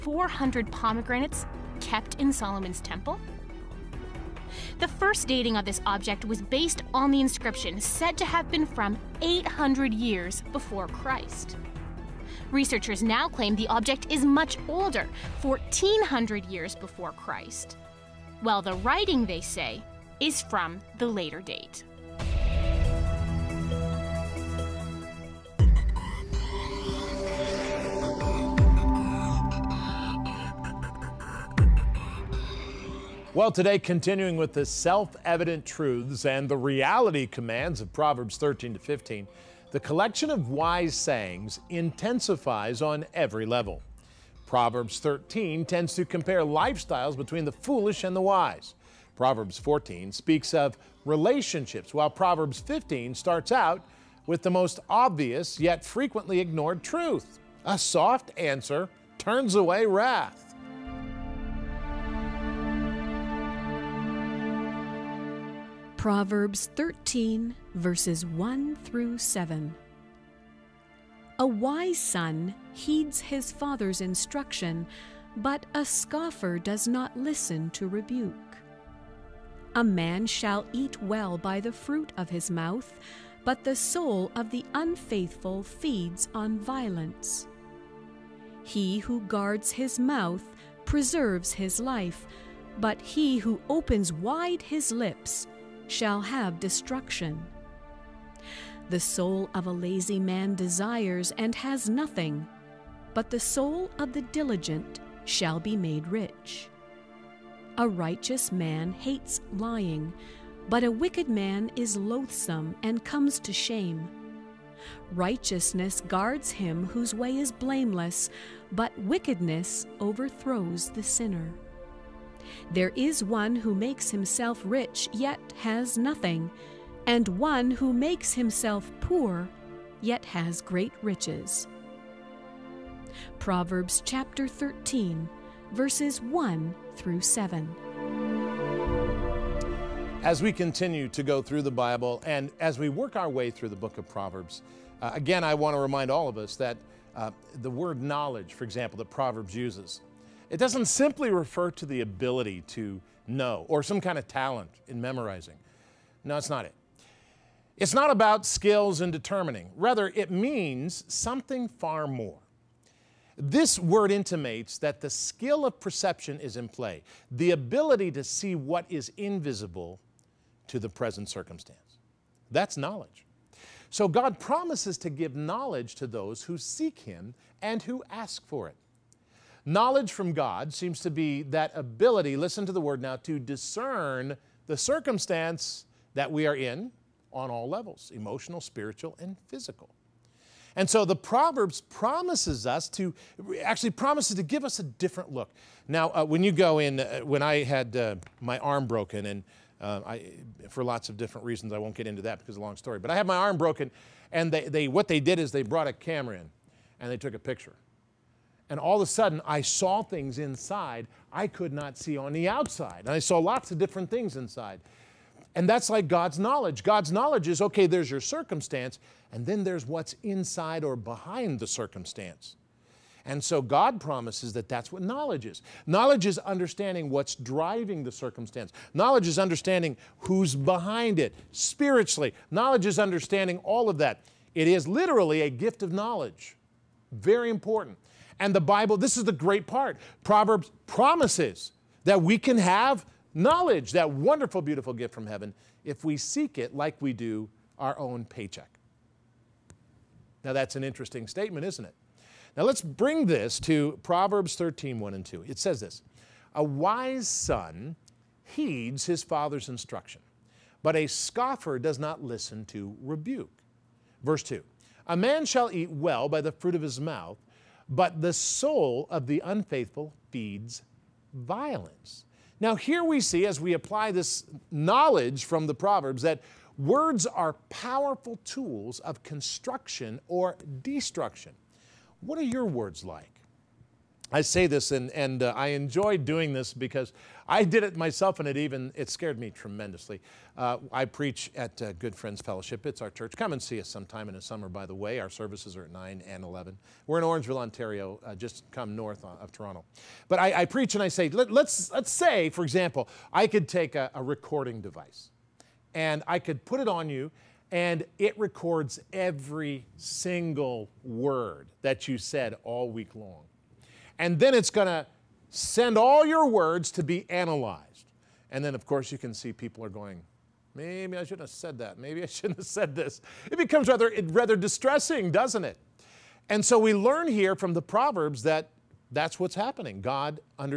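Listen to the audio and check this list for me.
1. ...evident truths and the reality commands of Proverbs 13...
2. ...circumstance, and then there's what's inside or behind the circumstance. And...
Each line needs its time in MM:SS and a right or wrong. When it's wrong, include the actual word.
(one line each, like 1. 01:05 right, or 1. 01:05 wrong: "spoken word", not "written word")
1. 00:35 right
2. 03:38 right.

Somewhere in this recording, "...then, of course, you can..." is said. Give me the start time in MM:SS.
05:18.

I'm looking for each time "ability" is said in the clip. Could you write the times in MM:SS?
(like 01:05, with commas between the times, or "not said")
02:32, 02:47, 03:01.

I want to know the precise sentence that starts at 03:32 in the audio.
And I saw lots of different things inside.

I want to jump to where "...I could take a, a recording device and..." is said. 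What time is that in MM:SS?
05:03.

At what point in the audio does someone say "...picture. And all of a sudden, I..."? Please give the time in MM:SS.
03:27.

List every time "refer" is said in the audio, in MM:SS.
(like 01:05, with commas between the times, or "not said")
02:31.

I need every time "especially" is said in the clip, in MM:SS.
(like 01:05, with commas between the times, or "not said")
not said.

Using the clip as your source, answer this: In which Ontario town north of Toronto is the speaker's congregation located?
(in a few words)
Orangeville.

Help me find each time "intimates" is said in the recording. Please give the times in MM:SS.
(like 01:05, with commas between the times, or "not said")
02:44.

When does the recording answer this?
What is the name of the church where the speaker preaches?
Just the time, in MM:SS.
04:51.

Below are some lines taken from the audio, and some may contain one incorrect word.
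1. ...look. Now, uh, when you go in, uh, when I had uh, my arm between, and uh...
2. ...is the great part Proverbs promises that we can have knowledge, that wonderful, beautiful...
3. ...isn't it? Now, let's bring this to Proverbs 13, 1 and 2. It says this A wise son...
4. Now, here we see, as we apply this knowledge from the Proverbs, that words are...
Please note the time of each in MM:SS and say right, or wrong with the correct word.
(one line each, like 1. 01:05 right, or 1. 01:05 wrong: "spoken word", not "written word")
1. 03:15 wrong: "broken", not "between"
2. 03:59 right
3. 04:11 right
4. 04:32 right.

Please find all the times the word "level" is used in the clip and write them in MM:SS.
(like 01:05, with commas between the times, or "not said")
00:43, 03:07.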